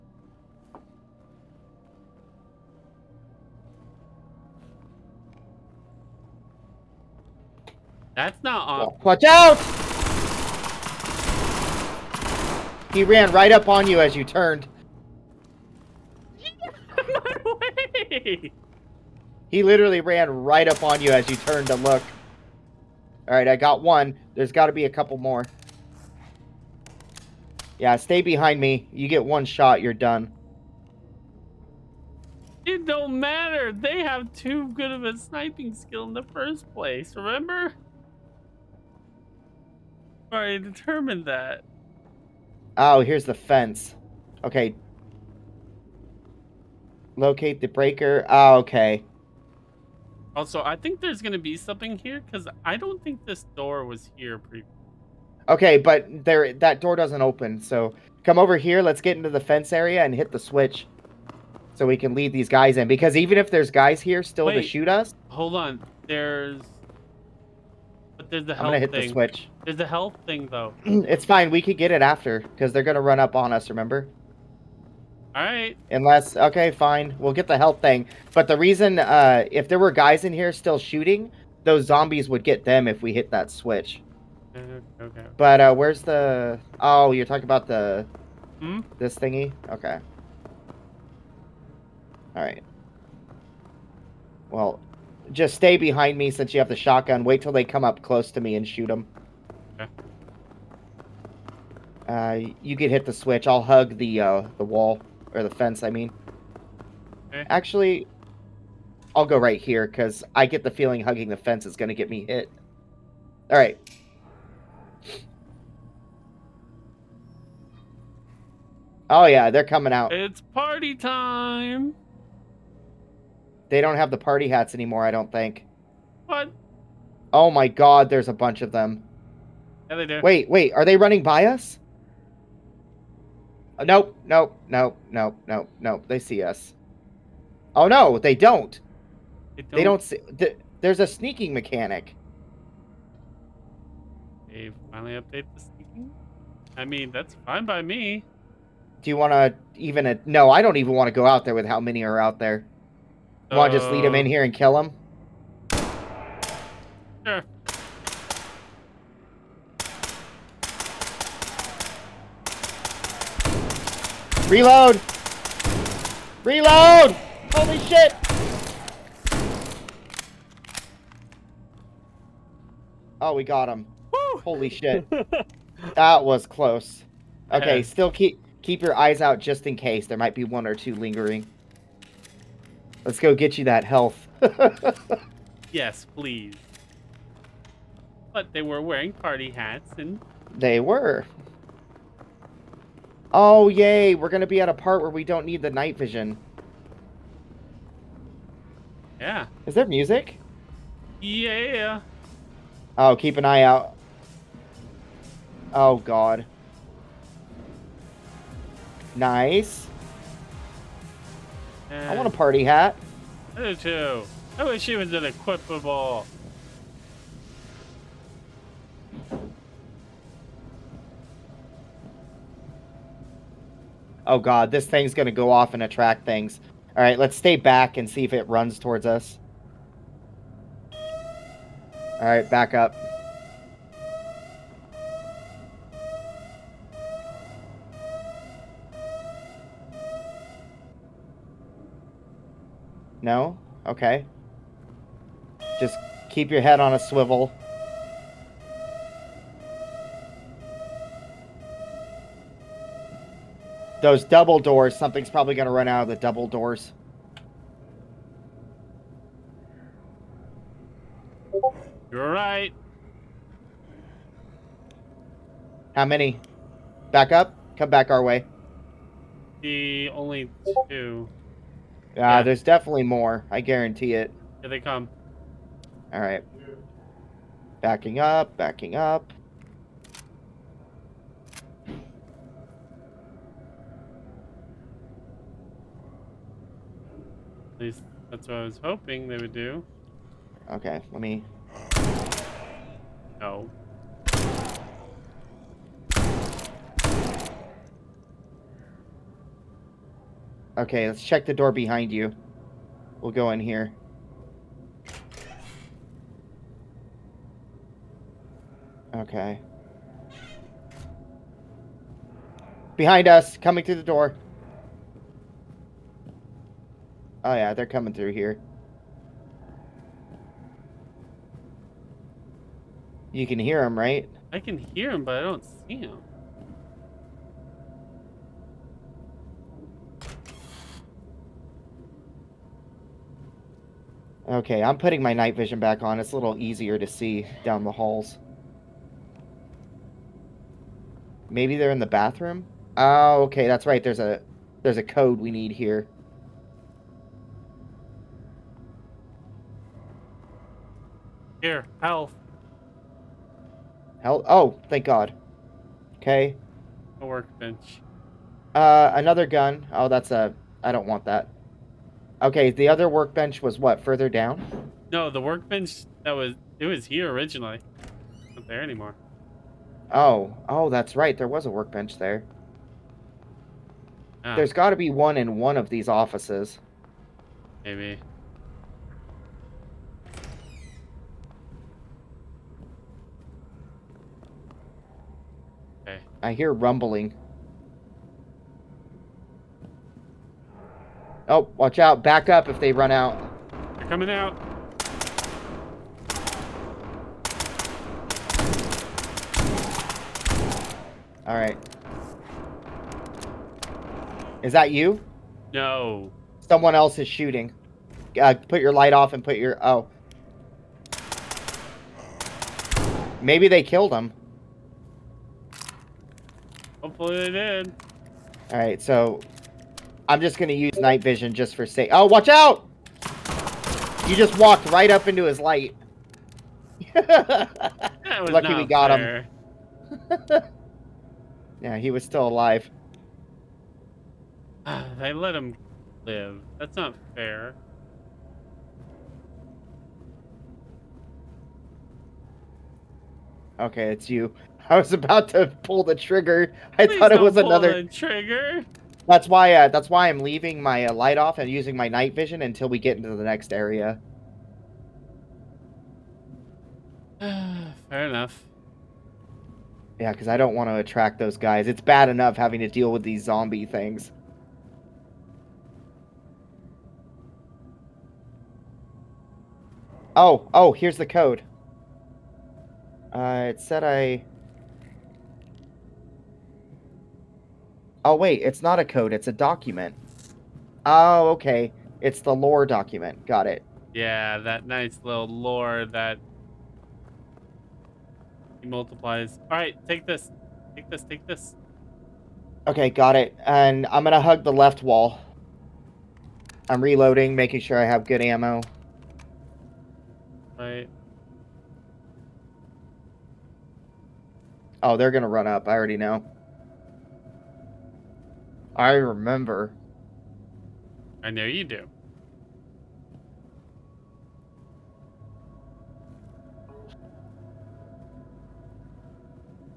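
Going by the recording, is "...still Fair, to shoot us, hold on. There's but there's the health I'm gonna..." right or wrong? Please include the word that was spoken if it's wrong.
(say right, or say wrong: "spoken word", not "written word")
wrong: "Wait", not "Fair".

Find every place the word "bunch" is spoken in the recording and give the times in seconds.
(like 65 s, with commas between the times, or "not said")
128 s.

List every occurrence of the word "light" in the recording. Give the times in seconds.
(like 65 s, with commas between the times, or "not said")
408 s, 425 s, 451 s.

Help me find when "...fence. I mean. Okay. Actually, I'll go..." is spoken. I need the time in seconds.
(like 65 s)
105 s.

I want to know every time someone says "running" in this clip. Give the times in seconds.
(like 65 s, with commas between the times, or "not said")
130 s.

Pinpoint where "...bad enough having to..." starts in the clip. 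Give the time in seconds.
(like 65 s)
461 s.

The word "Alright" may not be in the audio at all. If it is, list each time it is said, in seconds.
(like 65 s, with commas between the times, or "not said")
226 s, 232 s.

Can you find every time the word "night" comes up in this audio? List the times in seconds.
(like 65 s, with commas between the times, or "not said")
195 s, 335 s, 420 s, 452 s.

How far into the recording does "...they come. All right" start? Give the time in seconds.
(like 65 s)
274 s.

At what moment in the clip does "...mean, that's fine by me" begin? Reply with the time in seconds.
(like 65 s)
146 s.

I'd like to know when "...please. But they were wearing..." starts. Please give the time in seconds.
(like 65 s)
186 s.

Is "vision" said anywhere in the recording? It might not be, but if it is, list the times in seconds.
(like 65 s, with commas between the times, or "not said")
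195 s, 335 s, 421 s, 452 s.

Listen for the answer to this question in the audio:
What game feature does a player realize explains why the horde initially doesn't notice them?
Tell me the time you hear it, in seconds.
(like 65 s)
141 s.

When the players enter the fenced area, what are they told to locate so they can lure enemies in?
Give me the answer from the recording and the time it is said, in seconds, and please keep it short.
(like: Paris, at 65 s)
The breaker, at 47 s.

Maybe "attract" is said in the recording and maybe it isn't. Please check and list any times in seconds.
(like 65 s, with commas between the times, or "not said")
225 s, 460 s.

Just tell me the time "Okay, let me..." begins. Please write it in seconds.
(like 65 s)
290 s.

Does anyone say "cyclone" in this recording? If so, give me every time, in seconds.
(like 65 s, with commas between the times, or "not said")
not said.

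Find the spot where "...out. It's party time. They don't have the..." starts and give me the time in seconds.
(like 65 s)
119 s.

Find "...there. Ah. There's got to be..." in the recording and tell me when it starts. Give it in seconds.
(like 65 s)
372 s.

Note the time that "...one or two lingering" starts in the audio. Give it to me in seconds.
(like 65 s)
180 s.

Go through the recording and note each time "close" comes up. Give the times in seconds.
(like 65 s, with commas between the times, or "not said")
98 s, 176 s.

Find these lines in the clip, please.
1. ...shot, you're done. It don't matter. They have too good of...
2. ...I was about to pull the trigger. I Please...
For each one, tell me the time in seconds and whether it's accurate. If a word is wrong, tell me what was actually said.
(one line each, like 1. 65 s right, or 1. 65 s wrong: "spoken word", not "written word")
1. 29 s right
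2. 444 s right.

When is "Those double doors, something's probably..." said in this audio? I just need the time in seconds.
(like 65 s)
254 s.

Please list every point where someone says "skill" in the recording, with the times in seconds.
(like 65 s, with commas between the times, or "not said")
35 s.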